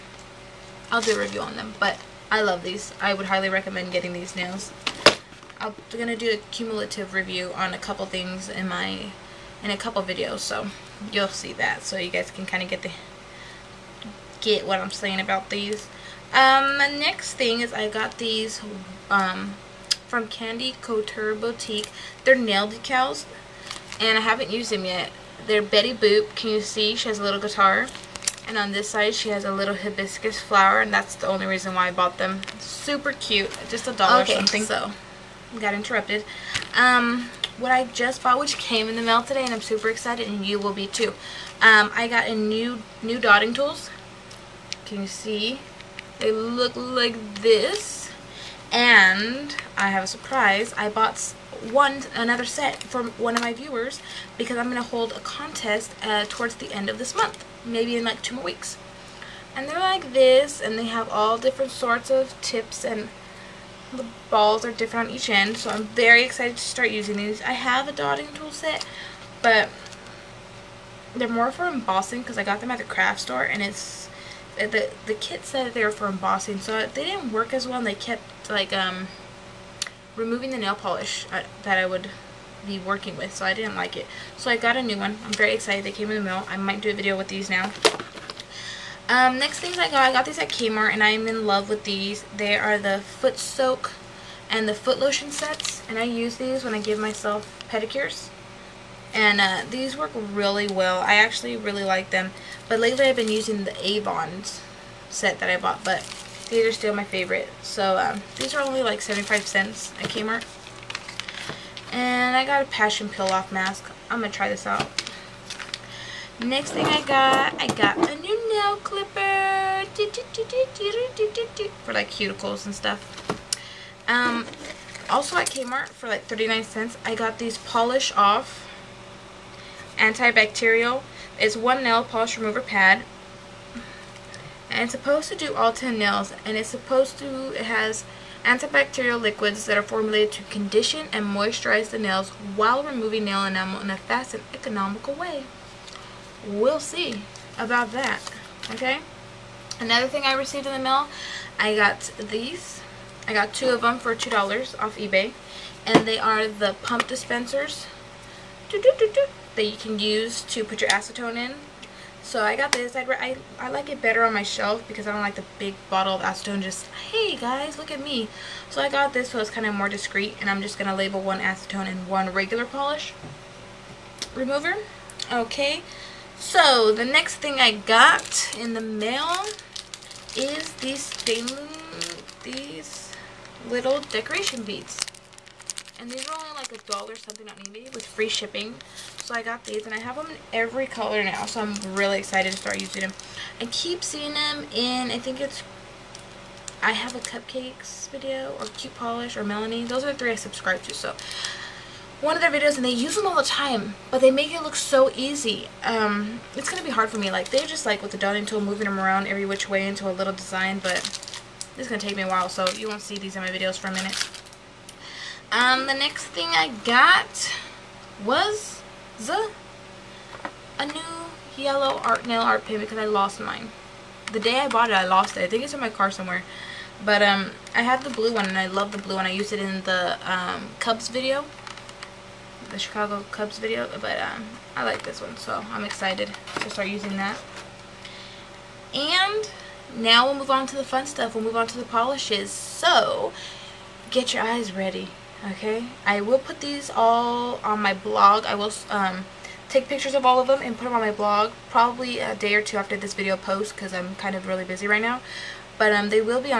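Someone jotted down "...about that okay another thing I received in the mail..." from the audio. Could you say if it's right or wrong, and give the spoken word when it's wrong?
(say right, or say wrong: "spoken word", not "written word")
right.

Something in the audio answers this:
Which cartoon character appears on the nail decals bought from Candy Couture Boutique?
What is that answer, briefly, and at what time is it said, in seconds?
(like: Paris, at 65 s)
Betty Boop, at 25 s.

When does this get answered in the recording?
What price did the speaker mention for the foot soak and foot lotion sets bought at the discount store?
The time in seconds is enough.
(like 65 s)
109 s.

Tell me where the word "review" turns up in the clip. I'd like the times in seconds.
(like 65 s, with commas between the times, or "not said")
1 s, 7 s.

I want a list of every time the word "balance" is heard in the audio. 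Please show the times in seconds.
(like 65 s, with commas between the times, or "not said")
not said.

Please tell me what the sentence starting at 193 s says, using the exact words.
I keep seeing them in, I think it's, I have a cupcakes video or cute polish or Melanie.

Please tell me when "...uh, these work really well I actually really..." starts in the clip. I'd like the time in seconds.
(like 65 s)
99 s.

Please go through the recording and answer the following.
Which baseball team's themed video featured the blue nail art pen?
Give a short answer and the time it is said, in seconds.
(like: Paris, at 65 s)
Chicago Cubs, at 232 s.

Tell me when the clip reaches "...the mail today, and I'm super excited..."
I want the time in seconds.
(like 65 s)
38 s.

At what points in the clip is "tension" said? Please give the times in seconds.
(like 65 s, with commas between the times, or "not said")
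not said.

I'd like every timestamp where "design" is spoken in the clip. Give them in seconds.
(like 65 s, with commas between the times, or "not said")
210 s.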